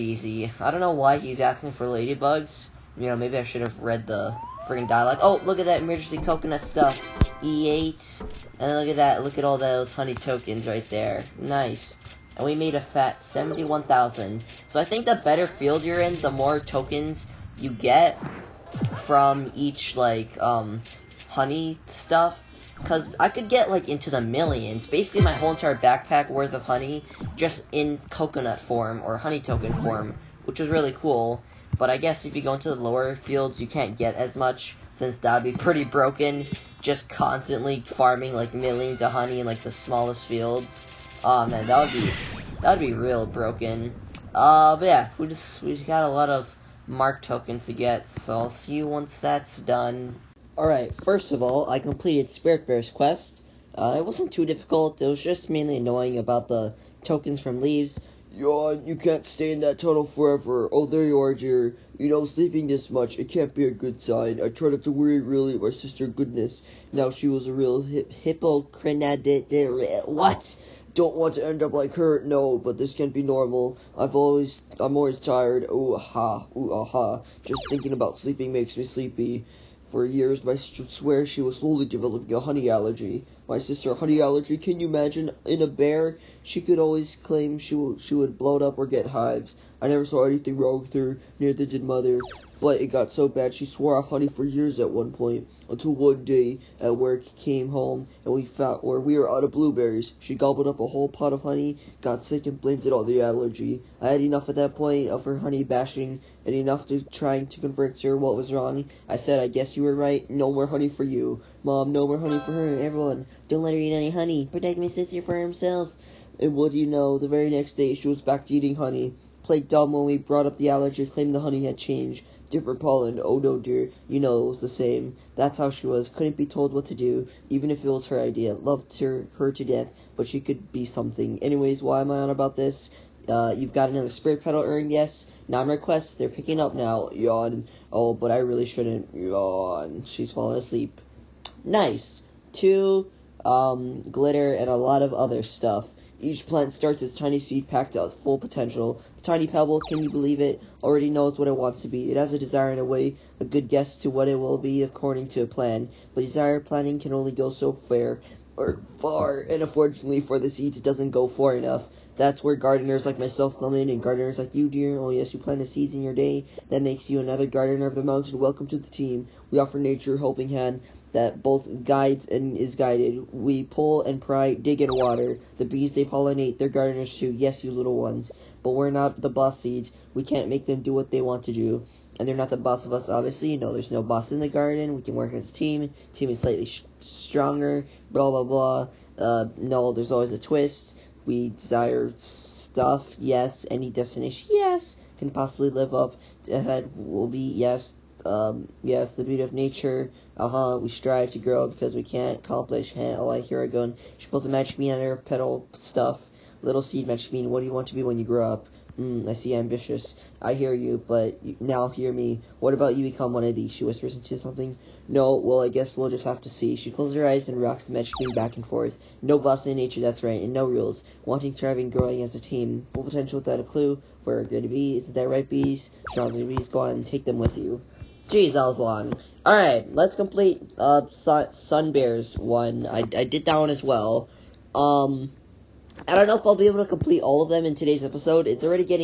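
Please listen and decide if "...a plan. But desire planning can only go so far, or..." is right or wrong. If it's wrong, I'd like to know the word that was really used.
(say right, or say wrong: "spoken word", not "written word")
right.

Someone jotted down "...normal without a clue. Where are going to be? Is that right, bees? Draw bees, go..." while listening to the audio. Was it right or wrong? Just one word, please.
wrong.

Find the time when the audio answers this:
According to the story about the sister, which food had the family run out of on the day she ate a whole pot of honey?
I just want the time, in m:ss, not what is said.
1:39.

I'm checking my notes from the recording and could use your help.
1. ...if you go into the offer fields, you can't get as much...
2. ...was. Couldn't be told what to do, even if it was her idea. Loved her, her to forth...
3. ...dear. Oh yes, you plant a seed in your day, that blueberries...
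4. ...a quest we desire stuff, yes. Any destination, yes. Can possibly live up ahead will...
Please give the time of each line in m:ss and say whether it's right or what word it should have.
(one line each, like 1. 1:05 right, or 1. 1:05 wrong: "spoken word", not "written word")
1. 0:32 wrong: "lower", not "offer"
2. 2:05 wrong: "death", not "forth"
3. 2:44 wrong: "makes", not "blueberries"
4. 3:10 wrong: "twist", not "quest".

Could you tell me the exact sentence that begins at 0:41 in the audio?
Oh, man, that would be, that would be real broken.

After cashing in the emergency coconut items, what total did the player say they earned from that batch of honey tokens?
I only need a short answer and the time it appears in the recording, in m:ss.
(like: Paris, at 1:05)
71,000, at 0:13.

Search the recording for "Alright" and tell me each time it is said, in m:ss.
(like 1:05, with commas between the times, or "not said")
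0:50, 3:49.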